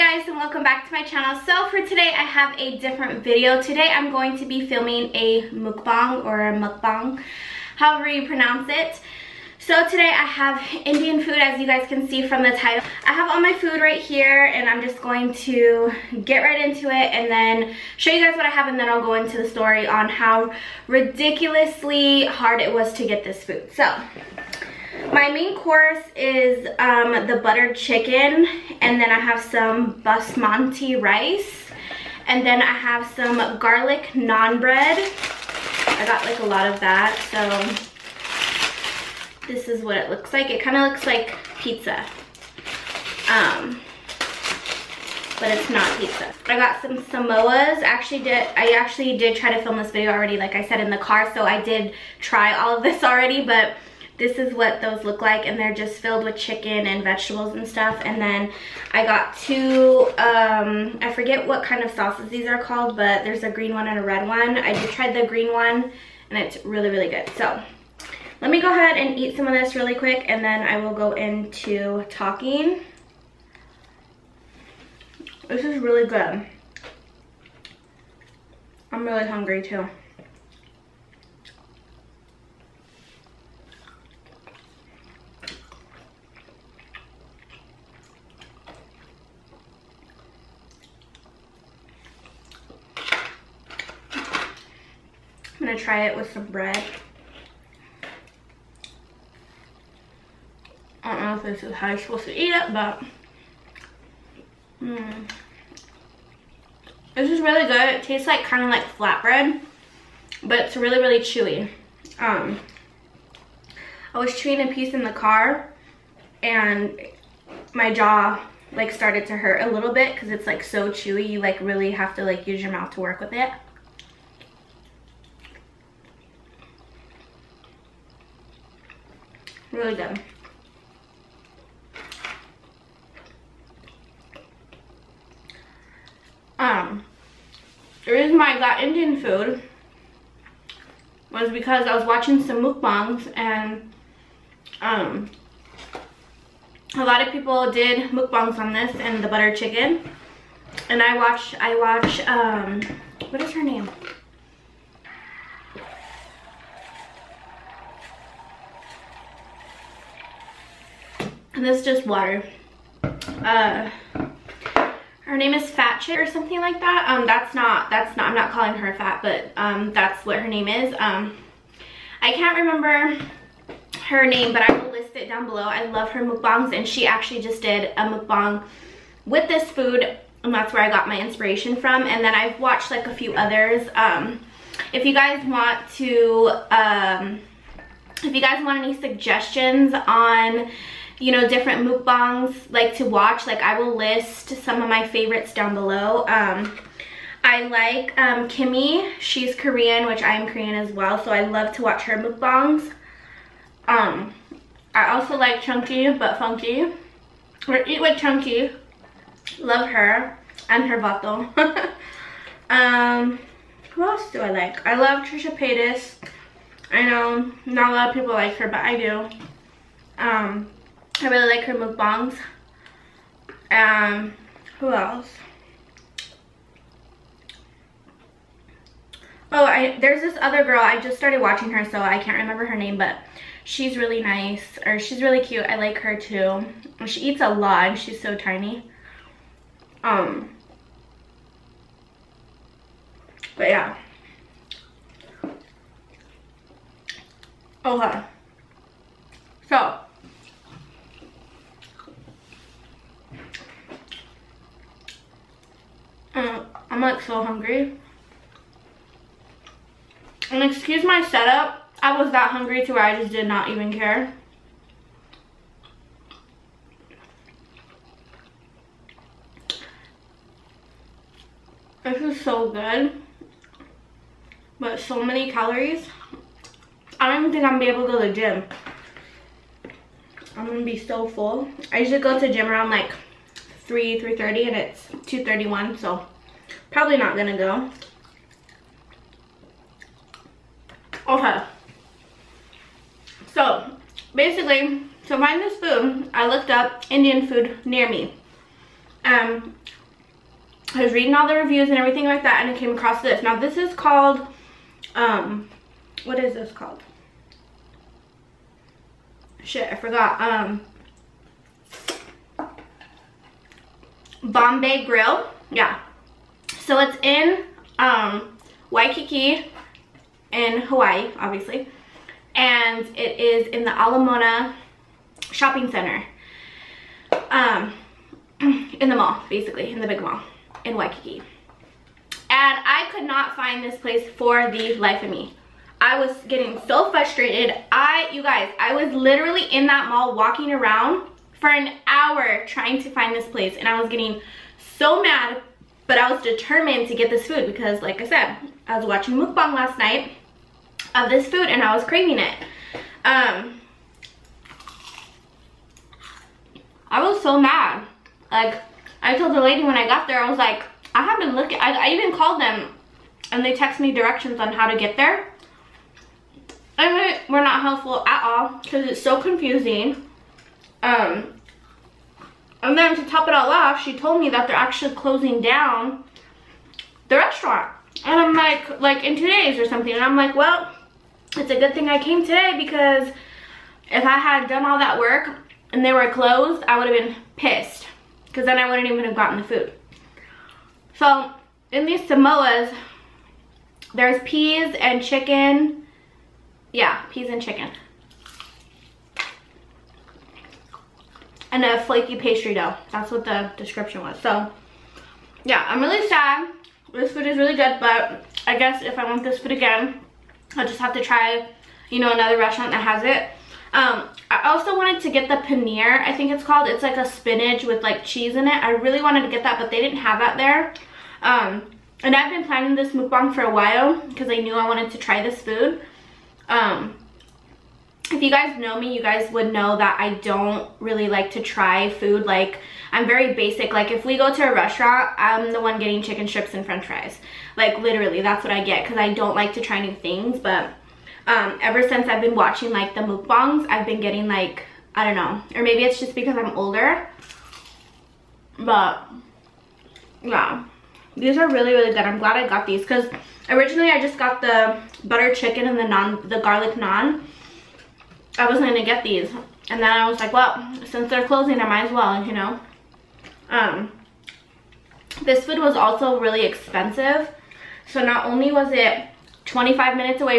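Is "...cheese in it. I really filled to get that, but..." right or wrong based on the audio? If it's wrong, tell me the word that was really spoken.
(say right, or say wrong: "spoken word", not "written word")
wrong: "wanted", not "filled".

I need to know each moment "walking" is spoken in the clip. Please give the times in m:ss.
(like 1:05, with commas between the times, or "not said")
5:40.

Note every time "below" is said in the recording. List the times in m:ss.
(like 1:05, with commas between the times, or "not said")
2:55, 3:15.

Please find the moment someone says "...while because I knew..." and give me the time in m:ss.
7:03.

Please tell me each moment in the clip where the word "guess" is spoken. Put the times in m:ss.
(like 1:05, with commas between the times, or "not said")
6:48.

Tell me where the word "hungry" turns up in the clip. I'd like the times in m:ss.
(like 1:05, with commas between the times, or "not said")
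1:19, 4:17, 4:22.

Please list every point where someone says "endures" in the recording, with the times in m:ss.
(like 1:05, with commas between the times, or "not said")
not said.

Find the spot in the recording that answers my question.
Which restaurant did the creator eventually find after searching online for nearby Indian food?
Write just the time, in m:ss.
5:14.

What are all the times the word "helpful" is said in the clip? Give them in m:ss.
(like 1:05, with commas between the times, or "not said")
6:07.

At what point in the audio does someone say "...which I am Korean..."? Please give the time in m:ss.
3:20.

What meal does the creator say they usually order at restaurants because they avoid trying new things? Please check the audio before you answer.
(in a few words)
chicken strips and french fries.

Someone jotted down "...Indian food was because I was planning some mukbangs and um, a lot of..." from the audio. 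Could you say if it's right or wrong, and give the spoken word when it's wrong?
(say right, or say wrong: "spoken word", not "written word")
wrong: "watching", not "planning".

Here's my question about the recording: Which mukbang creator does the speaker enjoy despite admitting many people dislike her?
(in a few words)
Trisha Paytas.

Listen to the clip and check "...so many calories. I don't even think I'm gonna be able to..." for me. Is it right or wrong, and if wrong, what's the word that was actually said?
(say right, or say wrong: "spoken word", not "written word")
right.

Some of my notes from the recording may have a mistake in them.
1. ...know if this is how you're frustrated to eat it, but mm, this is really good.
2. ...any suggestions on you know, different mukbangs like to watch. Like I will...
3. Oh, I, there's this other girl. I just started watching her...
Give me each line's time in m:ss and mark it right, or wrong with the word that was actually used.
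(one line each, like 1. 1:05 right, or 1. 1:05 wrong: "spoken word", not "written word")
1. 1:41 wrong: "supposed", not "frustrated"
2. 3:08 right
3. 3:49 right.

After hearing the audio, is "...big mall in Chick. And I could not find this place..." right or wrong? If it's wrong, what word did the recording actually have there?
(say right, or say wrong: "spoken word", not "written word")
wrong: "Waikiki", not "Chick".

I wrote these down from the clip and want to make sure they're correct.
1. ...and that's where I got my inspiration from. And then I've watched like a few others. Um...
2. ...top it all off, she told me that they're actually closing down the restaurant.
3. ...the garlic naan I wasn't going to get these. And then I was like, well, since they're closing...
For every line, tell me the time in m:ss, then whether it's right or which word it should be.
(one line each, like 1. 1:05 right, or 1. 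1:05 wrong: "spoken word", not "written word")
1. 3:00 right
2. 6:13 right
3. 7:36 right.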